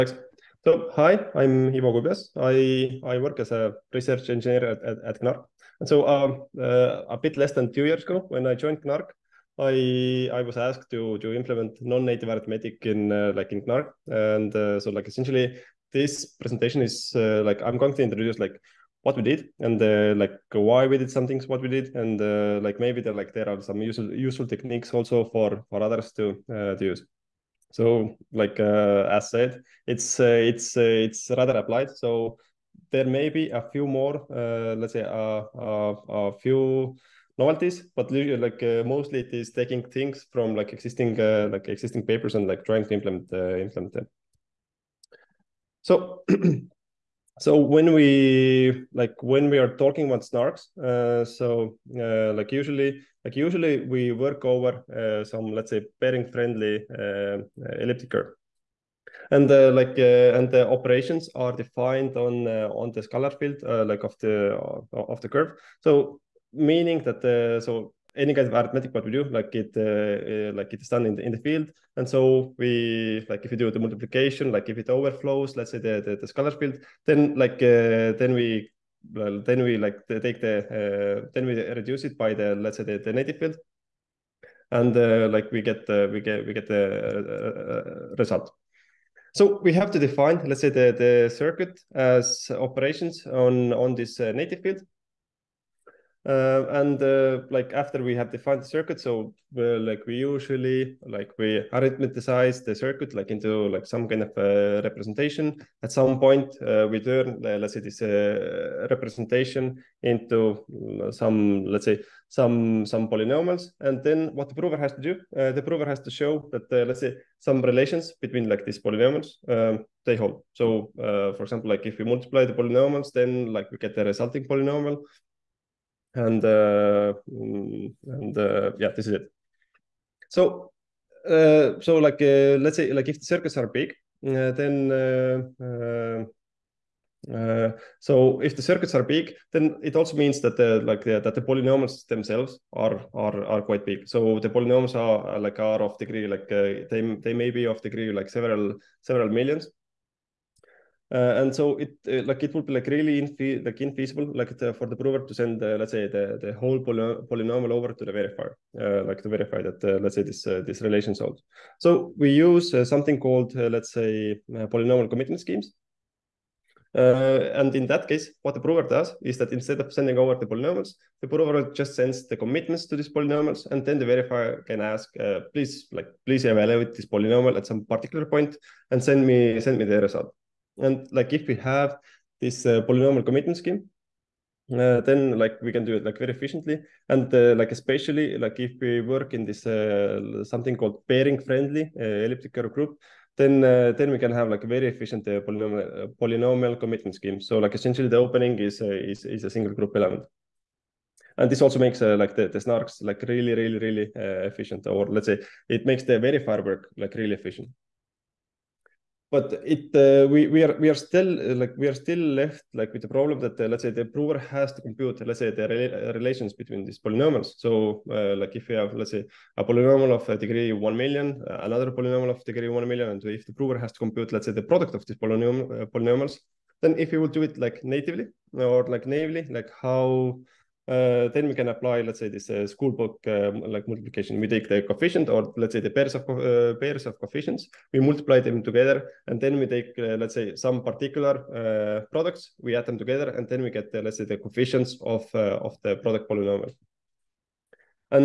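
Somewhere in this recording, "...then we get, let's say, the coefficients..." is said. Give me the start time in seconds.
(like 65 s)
243 s.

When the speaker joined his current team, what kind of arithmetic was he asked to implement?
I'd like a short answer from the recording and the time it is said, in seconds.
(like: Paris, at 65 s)
Non-native arithmetic, at 11 s.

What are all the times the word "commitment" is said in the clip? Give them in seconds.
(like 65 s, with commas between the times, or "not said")
165 s, 172 s, 183 s, 196 s.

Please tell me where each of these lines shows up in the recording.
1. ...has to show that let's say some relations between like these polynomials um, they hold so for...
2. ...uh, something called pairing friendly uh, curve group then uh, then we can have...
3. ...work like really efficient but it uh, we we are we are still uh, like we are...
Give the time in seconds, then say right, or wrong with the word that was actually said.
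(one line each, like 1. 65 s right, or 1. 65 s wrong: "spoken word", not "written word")
1. 115 s right
2. 189 s right
3. 206 s right.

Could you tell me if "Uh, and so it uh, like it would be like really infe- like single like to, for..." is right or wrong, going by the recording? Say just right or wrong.
wrong.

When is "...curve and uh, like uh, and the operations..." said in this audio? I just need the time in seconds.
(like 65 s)
58 s.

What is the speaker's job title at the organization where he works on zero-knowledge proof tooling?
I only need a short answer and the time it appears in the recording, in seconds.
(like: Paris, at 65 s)
Research engineer, at 3 s.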